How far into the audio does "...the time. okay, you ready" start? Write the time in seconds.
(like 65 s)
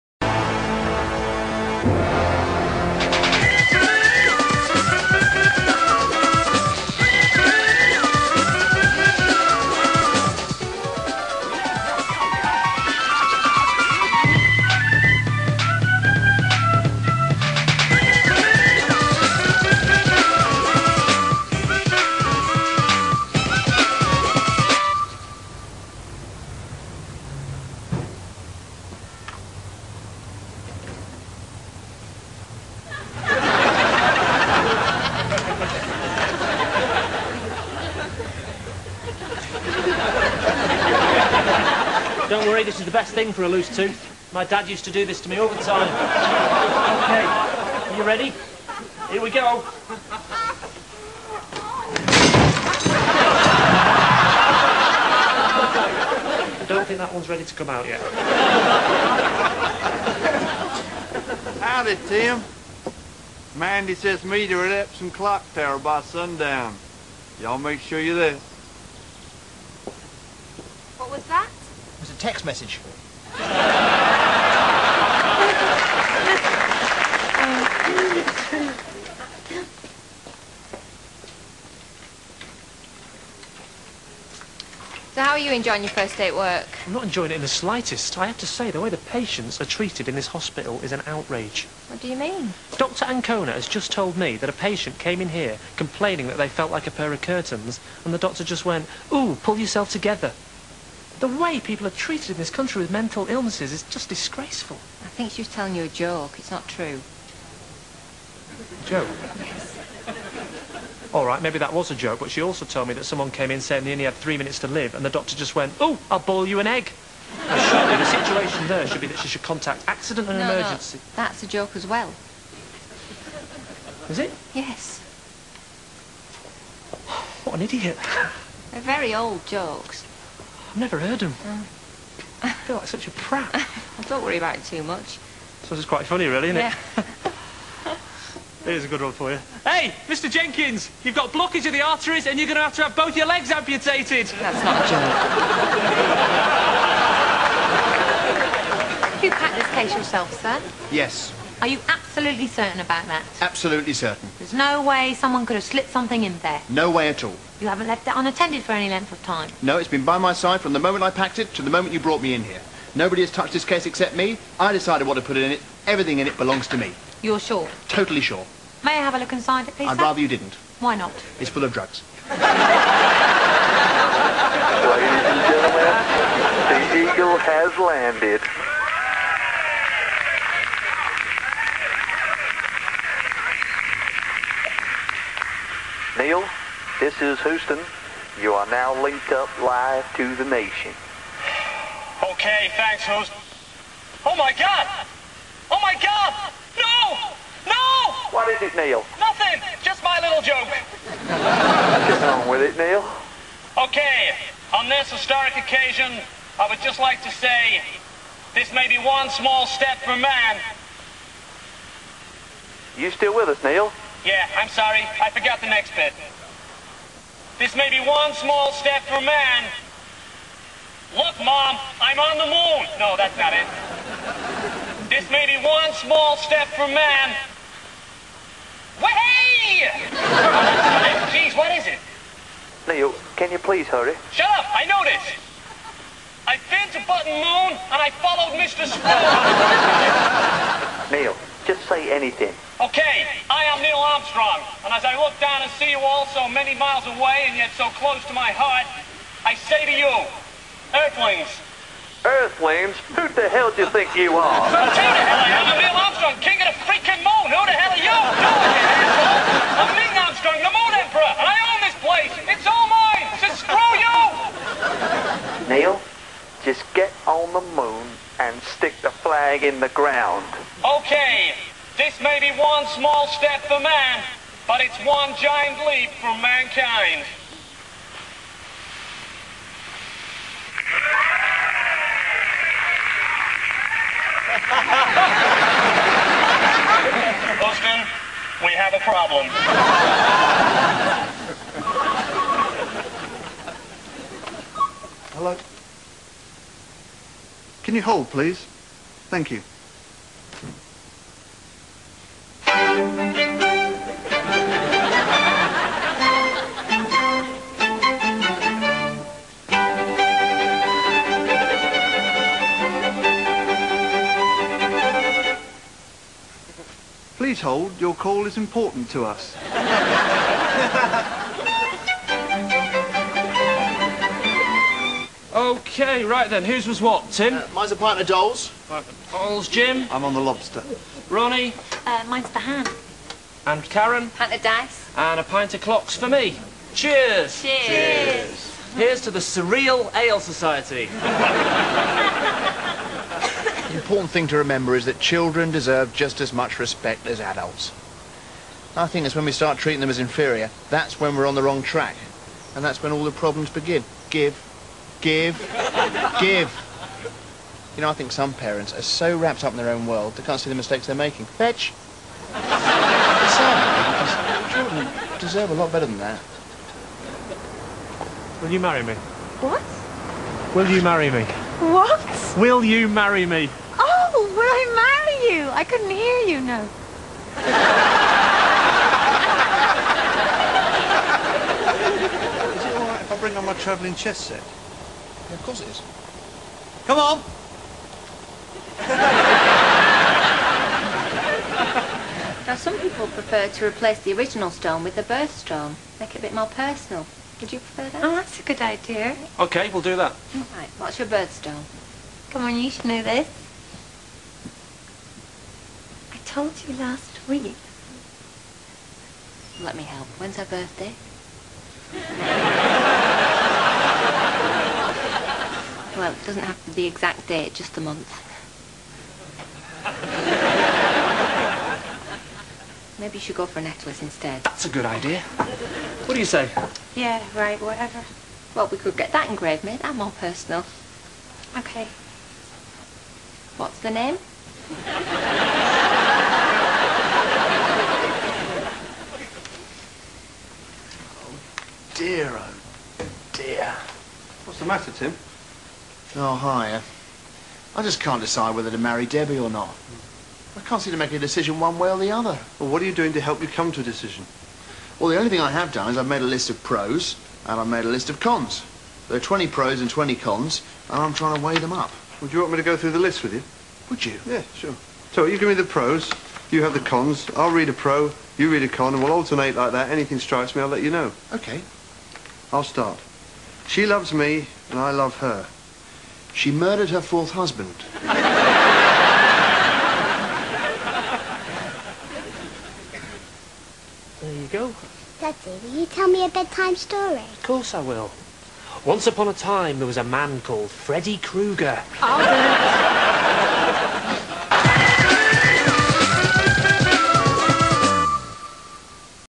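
45 s.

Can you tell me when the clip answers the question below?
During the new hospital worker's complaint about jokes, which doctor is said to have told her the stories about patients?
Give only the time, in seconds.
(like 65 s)
92 s.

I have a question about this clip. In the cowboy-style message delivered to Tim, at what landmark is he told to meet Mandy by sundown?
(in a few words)
Epsom Clock Tower.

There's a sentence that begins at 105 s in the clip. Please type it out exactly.
I think she was telling you a joke.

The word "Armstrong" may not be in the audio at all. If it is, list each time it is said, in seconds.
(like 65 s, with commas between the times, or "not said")
244 s, 256 s, 260 s.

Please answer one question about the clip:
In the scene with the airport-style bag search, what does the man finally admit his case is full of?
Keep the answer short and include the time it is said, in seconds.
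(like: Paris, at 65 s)
Drugs, at 171 s.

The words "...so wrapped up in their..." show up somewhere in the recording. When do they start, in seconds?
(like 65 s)
359 s.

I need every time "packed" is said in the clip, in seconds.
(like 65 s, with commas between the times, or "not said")
149 s, 161 s.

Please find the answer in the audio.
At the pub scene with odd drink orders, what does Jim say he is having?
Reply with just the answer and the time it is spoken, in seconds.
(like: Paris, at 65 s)
The lobster, at 330 s.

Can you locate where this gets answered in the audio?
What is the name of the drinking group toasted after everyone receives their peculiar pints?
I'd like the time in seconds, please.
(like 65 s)
339 s.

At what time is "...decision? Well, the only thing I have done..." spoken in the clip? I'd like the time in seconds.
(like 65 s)
454 s.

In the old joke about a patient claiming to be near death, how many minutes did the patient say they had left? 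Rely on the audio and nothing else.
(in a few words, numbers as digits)
3.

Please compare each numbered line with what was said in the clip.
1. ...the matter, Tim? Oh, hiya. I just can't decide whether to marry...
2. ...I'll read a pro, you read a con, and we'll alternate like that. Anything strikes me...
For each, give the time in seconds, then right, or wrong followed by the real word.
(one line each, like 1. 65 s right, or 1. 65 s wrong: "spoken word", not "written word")
1. 444 s right
2. 467 s right.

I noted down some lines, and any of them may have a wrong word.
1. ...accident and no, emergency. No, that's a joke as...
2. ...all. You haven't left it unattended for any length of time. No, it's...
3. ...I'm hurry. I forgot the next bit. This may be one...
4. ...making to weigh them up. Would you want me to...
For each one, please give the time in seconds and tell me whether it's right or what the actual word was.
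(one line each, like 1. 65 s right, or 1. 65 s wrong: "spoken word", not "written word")
1. 119 s right
2. 157 s right
3. 214 s wrong: "sorry", not "hurry"
4. 461 s wrong: "trying", not "making".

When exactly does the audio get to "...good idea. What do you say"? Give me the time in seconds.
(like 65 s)
424 s.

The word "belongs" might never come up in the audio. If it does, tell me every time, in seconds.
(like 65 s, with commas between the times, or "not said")
166 s.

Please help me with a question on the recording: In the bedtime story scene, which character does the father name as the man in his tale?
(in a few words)
Freddy Krueger.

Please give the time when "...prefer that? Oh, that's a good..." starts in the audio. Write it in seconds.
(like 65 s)
397 s.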